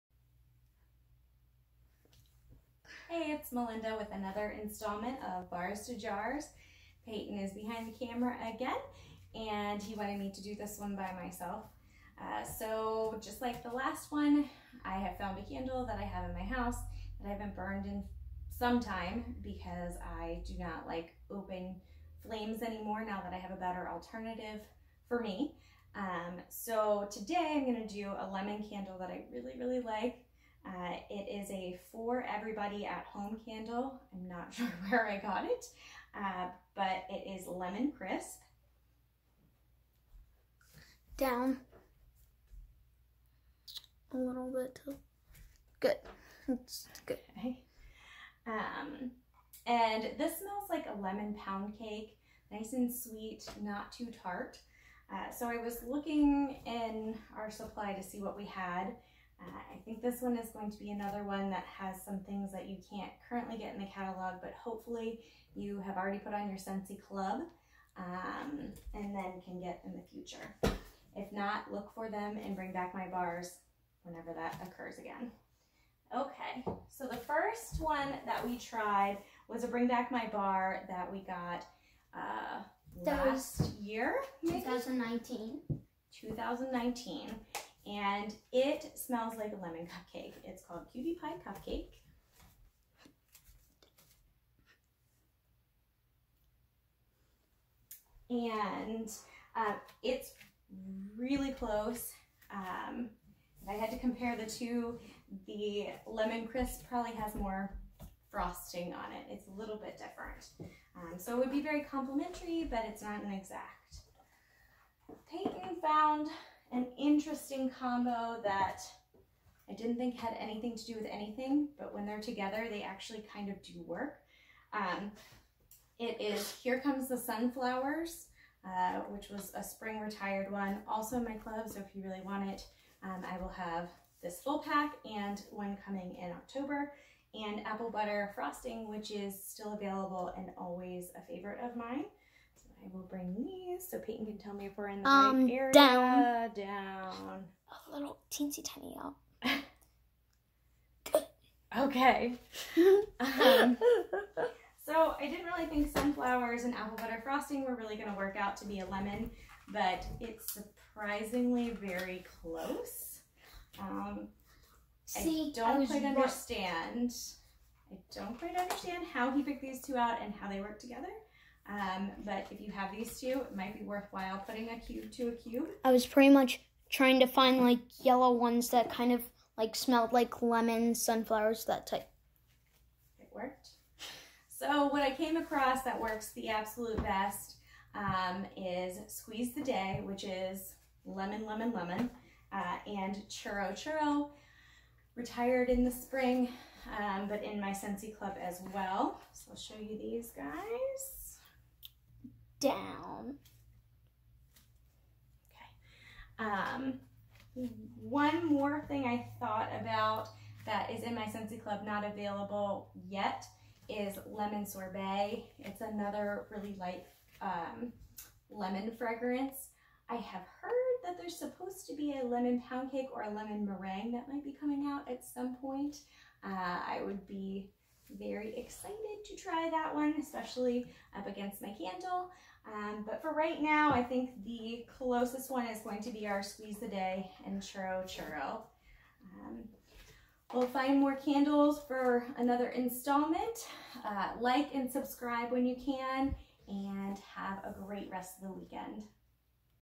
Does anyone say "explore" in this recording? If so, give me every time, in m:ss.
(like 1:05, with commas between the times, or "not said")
not said.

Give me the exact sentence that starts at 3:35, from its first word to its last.
It's another really light um, lemon fragrance.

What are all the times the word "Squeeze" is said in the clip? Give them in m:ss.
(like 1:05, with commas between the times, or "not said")
3:09, 3:56.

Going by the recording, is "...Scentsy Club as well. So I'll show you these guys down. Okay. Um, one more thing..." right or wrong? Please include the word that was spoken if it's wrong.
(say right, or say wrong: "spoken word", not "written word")
right.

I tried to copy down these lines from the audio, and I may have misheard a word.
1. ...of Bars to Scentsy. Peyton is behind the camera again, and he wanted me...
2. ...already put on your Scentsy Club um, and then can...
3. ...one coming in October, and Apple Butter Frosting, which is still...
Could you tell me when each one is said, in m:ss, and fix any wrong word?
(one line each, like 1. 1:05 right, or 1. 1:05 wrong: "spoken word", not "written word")
1. 0:05 wrong: "Jars", not "Scentsy"
2. 1:05 right
3. 2:15 right.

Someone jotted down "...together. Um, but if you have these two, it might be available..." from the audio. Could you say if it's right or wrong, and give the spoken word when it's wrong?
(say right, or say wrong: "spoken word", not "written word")
wrong: "worthwhile", not "available".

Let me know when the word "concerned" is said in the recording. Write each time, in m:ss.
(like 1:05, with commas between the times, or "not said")
not said.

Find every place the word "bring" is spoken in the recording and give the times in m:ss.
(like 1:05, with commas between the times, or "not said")
1:12, 1:19, 2:23.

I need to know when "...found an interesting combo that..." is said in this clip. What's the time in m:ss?
1:55.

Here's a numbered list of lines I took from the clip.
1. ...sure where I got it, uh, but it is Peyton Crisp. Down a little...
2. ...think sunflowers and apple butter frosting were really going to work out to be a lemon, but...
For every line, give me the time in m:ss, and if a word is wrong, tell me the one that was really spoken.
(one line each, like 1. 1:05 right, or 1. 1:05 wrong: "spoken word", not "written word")
1. 0:34 wrong: "Lemon", not "Peyton"
2. 2:35 right.